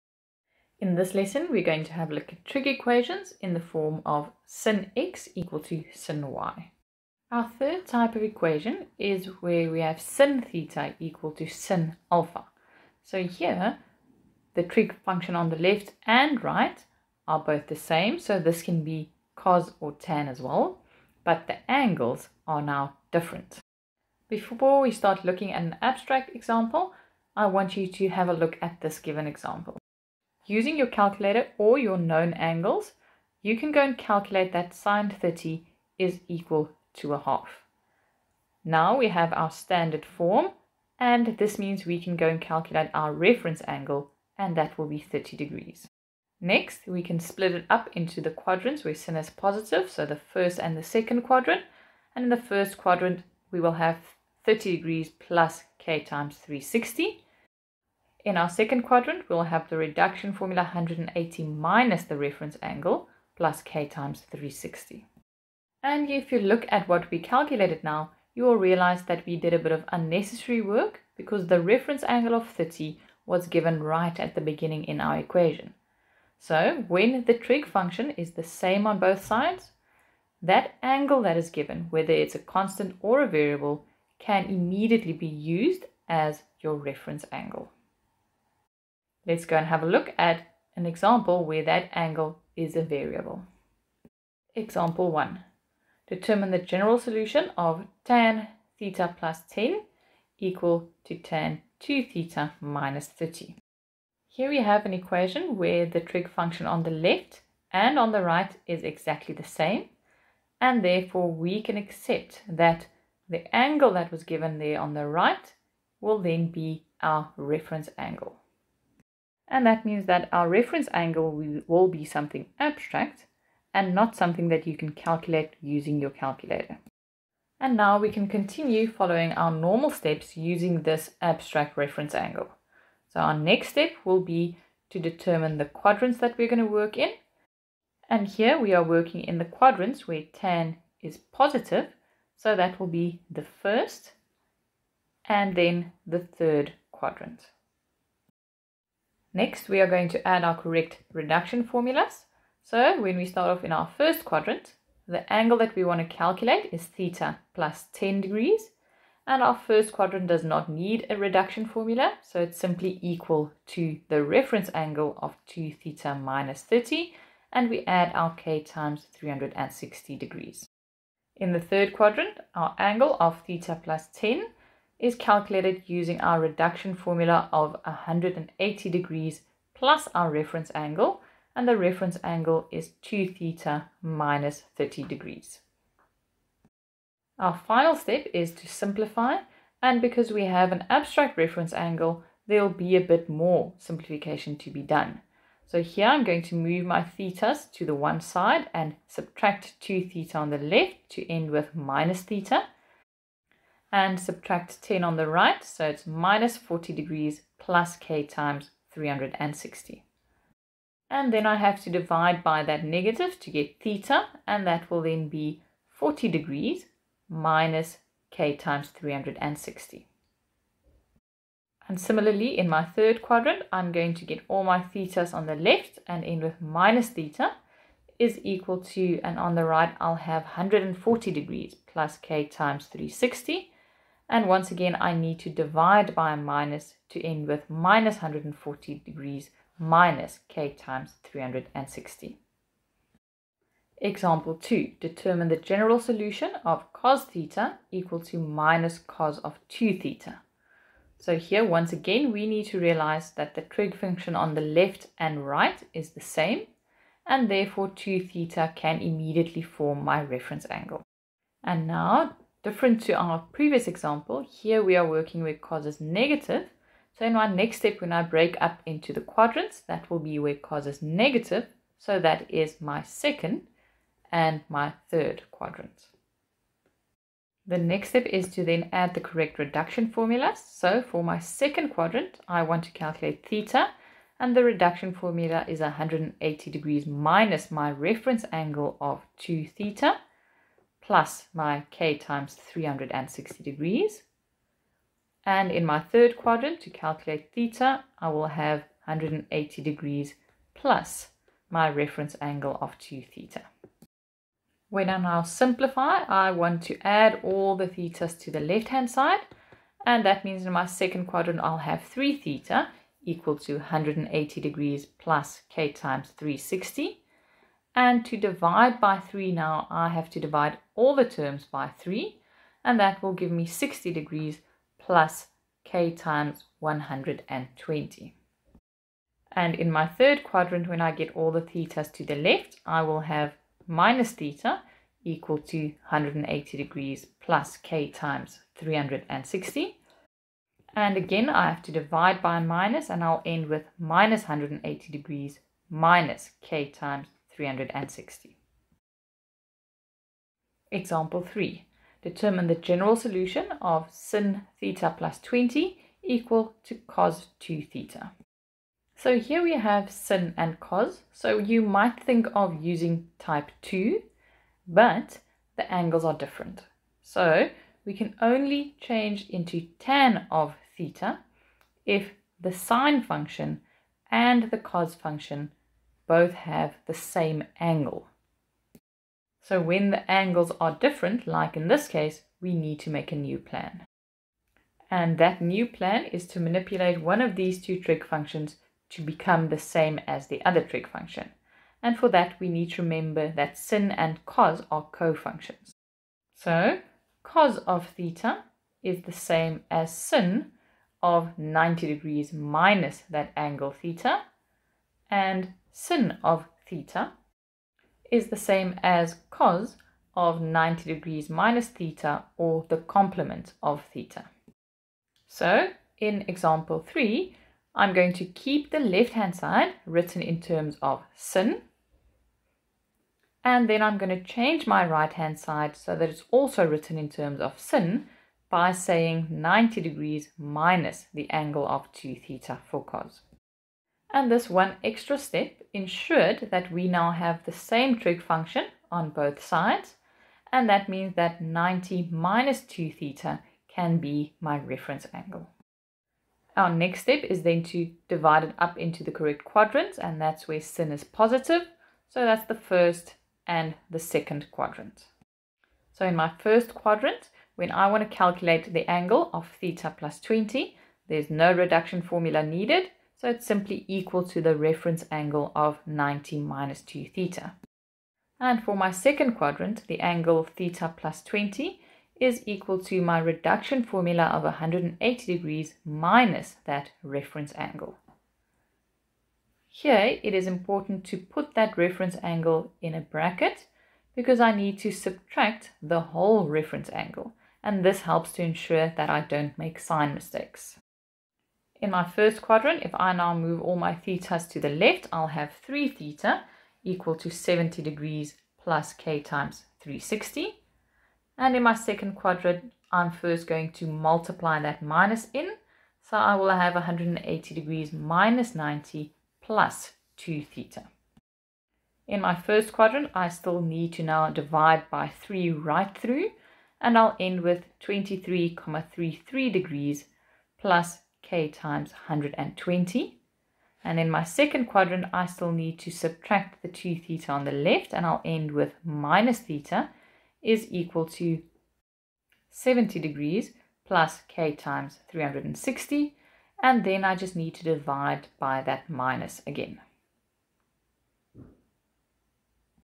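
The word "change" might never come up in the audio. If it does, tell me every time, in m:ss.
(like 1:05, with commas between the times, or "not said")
6:08, 7:04.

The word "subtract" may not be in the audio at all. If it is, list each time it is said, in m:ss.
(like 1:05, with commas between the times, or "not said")
3:19, 3:24, 8:05, 8:46.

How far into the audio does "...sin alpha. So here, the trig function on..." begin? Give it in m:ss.
0:11.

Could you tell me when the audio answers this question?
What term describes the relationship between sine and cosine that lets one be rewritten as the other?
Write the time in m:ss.
6:35.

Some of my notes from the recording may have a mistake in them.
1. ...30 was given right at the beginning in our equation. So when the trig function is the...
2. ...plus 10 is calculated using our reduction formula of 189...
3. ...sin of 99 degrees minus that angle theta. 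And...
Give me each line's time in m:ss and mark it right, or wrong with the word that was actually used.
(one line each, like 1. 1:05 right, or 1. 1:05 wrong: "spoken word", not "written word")
1. 1:12 right
2. 2:53 wrong: "180", not "189"
3. 6:40 wrong: "90", not "99".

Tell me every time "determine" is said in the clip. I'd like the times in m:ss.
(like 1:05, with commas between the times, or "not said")
1:36, 2:14, 4:05, 5:52.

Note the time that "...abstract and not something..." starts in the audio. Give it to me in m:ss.
2:02.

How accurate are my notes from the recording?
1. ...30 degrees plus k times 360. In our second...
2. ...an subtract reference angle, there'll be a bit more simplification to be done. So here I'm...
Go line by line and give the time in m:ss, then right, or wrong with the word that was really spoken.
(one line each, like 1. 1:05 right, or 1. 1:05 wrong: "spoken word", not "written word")
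1. 0:54 right
2. 3:10 wrong: "abstract", not "subtract".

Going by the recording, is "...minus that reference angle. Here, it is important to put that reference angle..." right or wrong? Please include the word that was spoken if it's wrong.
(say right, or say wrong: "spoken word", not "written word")
right.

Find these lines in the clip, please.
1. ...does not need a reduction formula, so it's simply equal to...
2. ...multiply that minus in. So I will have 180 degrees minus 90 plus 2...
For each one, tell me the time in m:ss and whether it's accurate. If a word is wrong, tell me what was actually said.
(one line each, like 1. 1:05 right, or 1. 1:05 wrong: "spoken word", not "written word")
1. 2:40 right
2. 8:24 right.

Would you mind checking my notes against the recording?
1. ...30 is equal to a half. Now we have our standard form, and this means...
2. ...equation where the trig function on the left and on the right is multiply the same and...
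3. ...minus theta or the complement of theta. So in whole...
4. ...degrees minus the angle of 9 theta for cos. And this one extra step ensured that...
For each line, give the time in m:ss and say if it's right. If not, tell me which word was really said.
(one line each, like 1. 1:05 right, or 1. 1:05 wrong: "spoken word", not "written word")
1. 0:35 right
2. 1:44 wrong: "exactly", not "multiply"
3. 6:51 wrong: "example", not "whole"
4. 7:10 wrong: "2", not "9".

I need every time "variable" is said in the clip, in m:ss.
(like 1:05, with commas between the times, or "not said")
1:23, 1:32.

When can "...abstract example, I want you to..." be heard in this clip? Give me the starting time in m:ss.
0:25.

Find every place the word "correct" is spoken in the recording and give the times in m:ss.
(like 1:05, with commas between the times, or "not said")
2:30, 4:39, 7:29.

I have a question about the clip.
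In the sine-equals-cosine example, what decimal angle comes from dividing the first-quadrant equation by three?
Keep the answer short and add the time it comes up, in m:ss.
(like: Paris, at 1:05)
23.33 degrees, at 8:37.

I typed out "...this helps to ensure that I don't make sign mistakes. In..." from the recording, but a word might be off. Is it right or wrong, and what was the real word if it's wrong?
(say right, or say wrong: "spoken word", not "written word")
right.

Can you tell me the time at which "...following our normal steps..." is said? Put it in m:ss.
2:08.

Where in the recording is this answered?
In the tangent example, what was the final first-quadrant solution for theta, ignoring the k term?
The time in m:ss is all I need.
3:35.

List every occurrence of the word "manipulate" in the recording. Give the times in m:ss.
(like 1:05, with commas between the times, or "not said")
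6:26.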